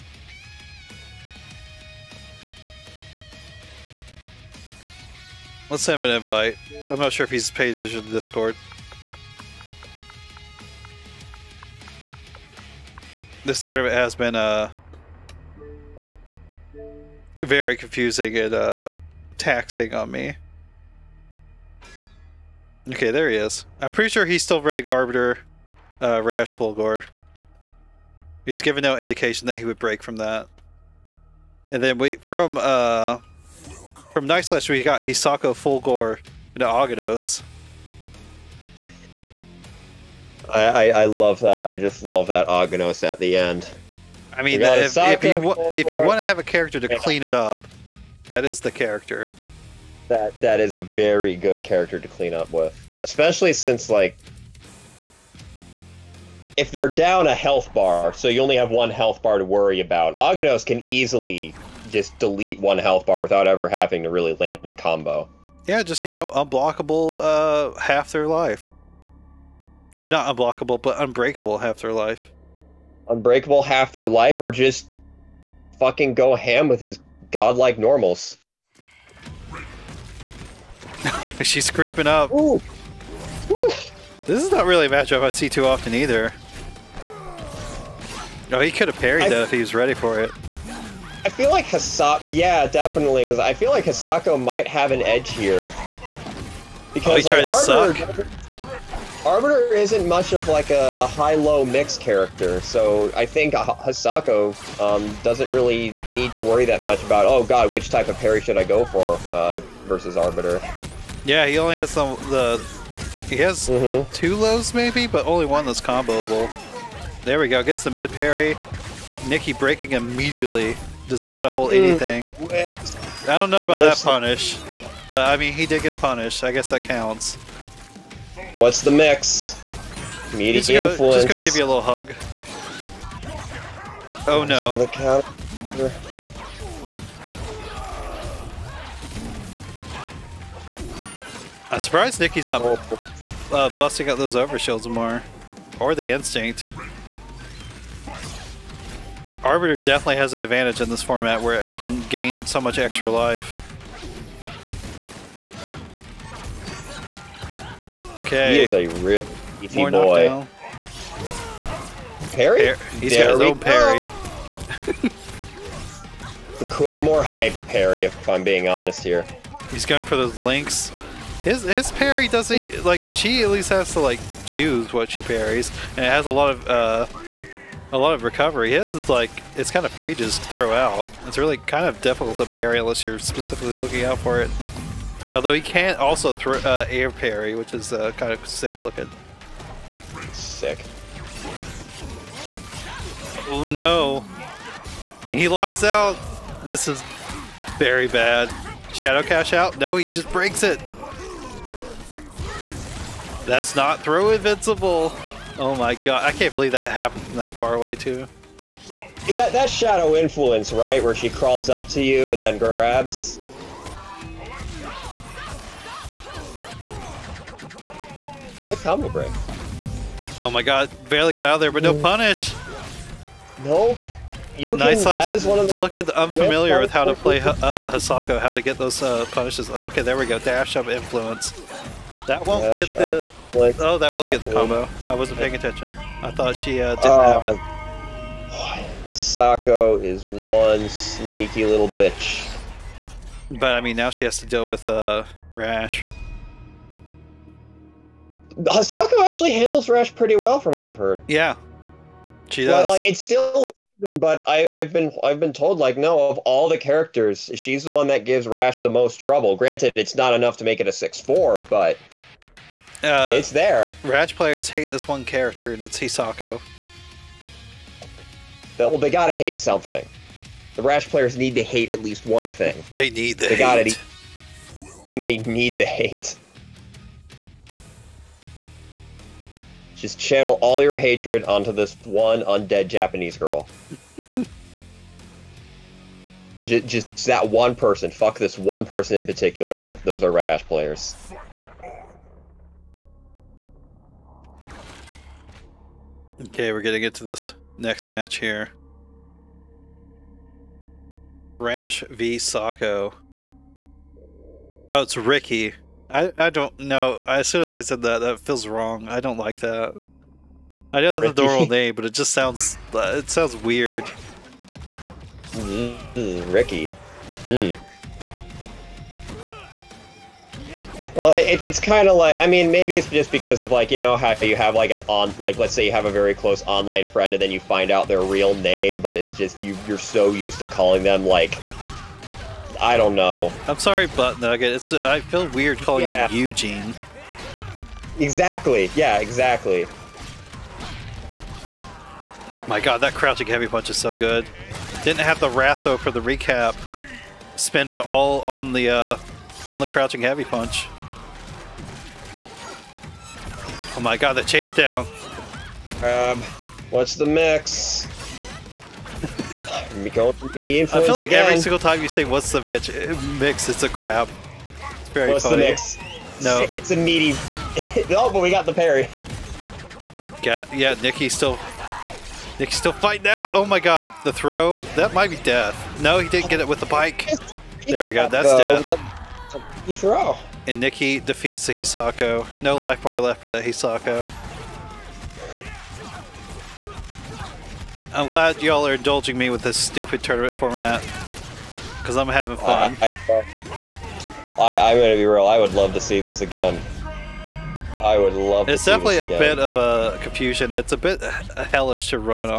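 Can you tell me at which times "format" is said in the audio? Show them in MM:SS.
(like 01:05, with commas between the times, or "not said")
02:31, 06:30.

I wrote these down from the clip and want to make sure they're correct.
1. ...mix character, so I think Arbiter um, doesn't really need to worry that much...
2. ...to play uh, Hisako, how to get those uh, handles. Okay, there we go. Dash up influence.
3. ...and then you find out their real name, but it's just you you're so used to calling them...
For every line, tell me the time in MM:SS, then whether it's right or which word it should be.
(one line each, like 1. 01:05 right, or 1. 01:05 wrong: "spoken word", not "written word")
1. 01:41 wrong: "Hisako", not "Arbiter"
2. 03:47 wrong: "punishes", not "handles"
3. 05:27 right.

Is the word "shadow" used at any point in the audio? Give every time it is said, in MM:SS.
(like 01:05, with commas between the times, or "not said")
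03:18, 03:29.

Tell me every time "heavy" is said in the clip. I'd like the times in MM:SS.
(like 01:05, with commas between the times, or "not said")
05:43, 05:50.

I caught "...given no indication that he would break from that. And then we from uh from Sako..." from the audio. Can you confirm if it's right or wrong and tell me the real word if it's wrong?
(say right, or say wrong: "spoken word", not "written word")
wrong: "Night", not "Sako".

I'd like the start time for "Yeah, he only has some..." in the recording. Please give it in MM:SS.
01:51.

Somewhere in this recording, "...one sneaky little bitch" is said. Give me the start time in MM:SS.
04:00.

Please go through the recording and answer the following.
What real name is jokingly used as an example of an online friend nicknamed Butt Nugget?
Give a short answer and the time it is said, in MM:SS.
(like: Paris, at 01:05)
Eugene, at 05:36.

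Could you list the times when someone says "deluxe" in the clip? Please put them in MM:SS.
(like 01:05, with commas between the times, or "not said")
not said.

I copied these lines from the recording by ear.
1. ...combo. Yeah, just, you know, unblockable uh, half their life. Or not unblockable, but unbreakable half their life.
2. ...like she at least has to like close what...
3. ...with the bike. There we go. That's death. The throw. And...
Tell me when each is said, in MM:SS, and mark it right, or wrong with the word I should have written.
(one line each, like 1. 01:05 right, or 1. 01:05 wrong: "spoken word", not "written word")
1. 01:04 right
2. 02:52 wrong: "choose", not "close"
3. 06:16 right.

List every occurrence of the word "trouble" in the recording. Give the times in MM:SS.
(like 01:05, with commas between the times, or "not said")
04:19.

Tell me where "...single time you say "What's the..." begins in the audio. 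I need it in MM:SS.
06:01.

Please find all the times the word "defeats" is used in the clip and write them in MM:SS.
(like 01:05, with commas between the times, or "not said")
06:21.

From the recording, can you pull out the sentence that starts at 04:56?
Okay, we're gonna get to this next match here.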